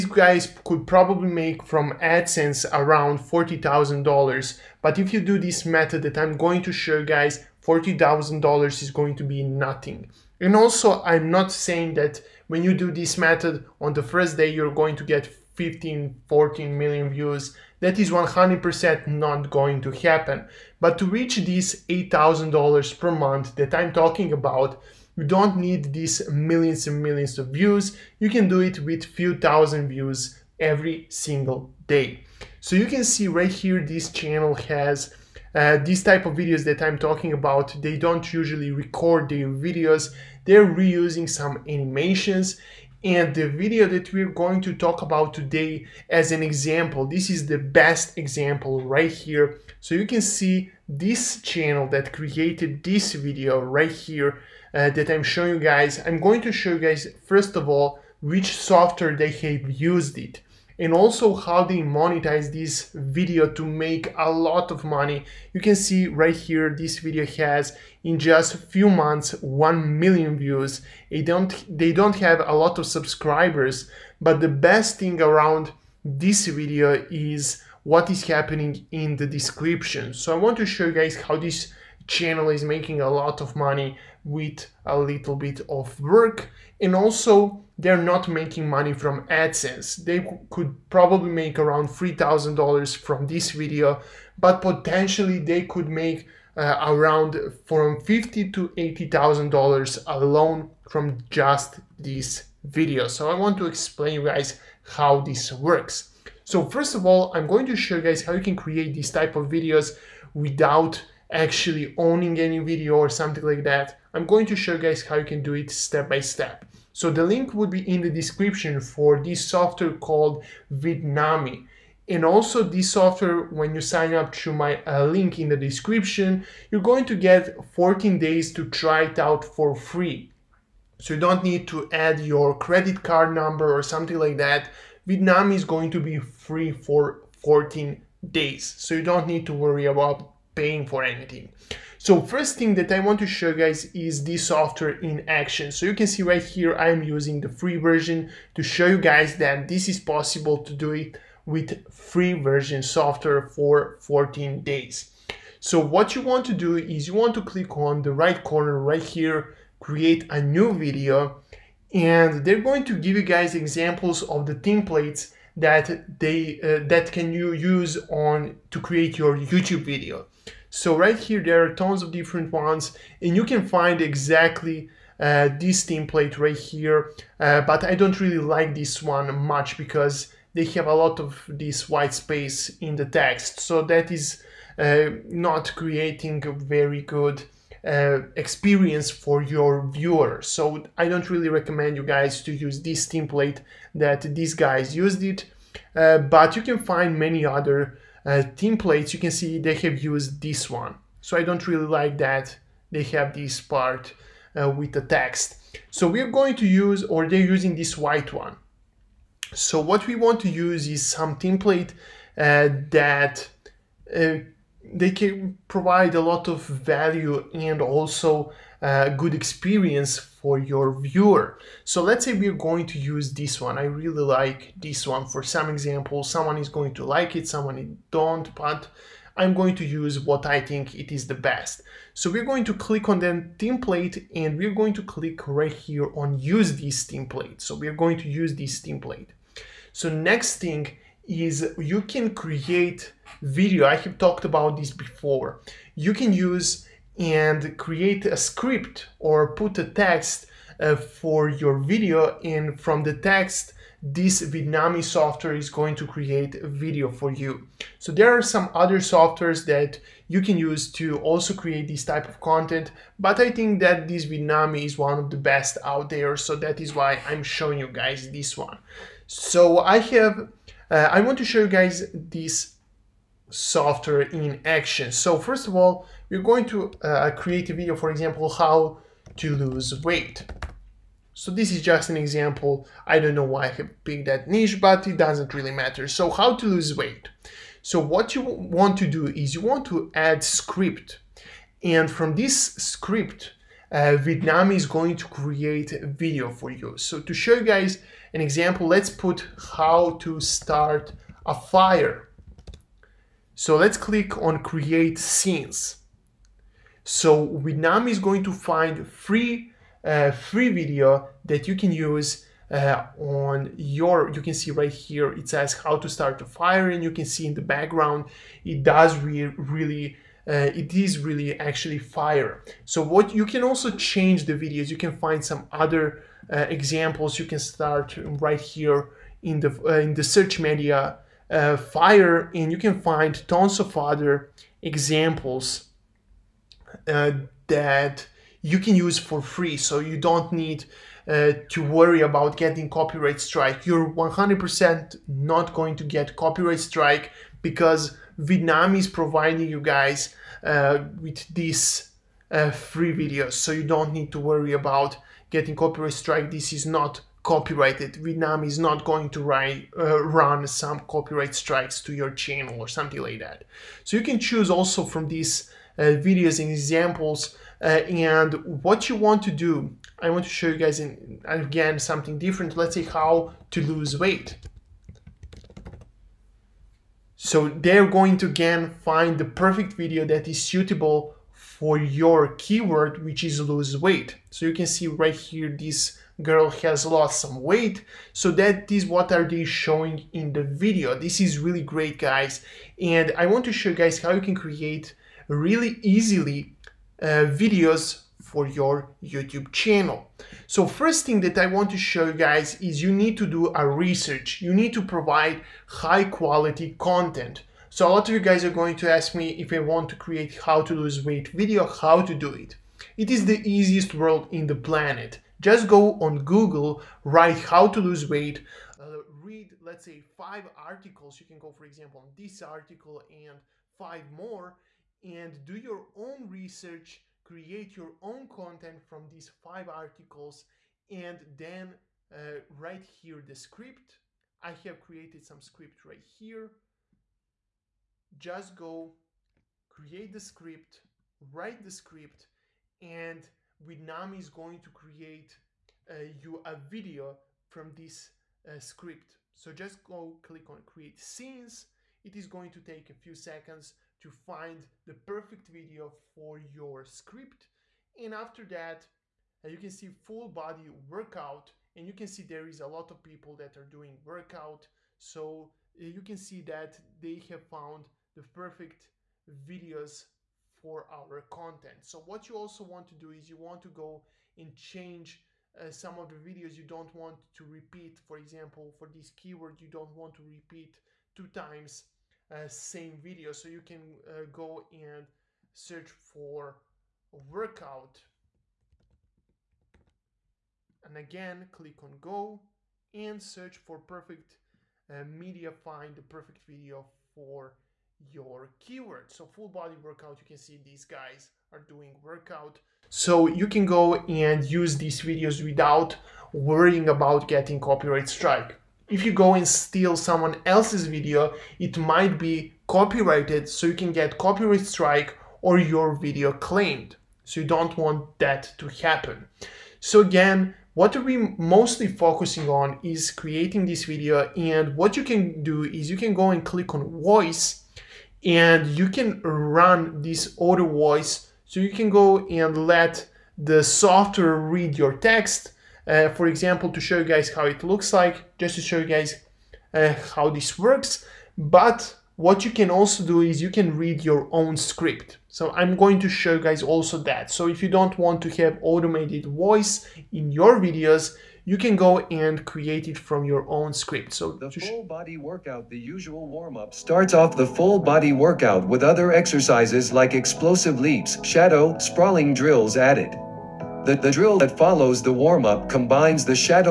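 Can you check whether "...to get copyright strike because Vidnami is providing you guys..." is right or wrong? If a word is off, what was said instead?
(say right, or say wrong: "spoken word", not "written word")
right.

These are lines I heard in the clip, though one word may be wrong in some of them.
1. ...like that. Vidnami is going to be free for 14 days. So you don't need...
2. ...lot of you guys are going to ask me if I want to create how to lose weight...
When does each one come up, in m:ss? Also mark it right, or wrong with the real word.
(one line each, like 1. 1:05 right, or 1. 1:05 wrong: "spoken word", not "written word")
1. 2:14 right
2. 6:48 right.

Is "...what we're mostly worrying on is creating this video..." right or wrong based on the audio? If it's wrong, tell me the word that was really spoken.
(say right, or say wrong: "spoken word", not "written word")
wrong: "focusing", not "worrying".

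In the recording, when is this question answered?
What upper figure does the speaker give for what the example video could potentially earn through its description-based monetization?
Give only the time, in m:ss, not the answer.
1:38.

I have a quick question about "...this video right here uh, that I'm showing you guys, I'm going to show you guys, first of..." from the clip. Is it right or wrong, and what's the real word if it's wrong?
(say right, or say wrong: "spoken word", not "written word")
right.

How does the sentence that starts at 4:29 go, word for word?
So I have uh, I want to show you guys this software in action.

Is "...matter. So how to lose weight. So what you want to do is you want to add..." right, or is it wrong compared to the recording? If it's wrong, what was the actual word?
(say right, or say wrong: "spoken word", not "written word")
right.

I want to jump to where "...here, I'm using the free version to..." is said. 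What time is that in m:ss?
2:26.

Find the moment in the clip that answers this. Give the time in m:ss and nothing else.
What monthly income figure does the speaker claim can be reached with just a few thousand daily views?
0:21.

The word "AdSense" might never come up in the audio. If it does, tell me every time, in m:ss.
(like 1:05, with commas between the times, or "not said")
0:02, 1:29.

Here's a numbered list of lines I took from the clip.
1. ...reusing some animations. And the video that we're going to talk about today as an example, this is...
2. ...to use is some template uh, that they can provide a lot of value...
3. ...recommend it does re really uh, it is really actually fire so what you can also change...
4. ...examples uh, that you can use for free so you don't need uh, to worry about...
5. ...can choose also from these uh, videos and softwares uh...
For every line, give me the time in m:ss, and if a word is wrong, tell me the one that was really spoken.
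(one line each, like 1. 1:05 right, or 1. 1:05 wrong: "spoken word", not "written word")
1. 0:40 right
2. 3:30 right
3. 5:17 wrong: "background", not "recommend"
4. 5:34 right
5. 6:04 wrong: "examples", not "softwares".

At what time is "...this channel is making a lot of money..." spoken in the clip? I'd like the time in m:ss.
1:21.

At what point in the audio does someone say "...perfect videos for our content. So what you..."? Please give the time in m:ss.
7:48.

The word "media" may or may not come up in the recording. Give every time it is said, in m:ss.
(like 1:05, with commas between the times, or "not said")
5:30, 8:15.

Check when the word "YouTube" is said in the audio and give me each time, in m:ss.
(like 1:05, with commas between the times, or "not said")
2:49, 6:39.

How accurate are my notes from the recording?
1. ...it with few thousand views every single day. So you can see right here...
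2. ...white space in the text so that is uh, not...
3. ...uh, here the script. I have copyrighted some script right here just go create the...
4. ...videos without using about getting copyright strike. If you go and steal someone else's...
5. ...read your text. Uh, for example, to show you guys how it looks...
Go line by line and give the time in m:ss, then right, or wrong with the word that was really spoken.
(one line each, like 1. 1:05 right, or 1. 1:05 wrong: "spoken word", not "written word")
1. 0:28 right
2. 3:01 right
3. 7:12 wrong: "created", not "copyrighted"
4. 8:25 wrong: "worrying", not "using"
5. 8:54 right.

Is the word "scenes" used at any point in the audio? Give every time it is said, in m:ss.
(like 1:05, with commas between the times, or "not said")
5:05, 7:31.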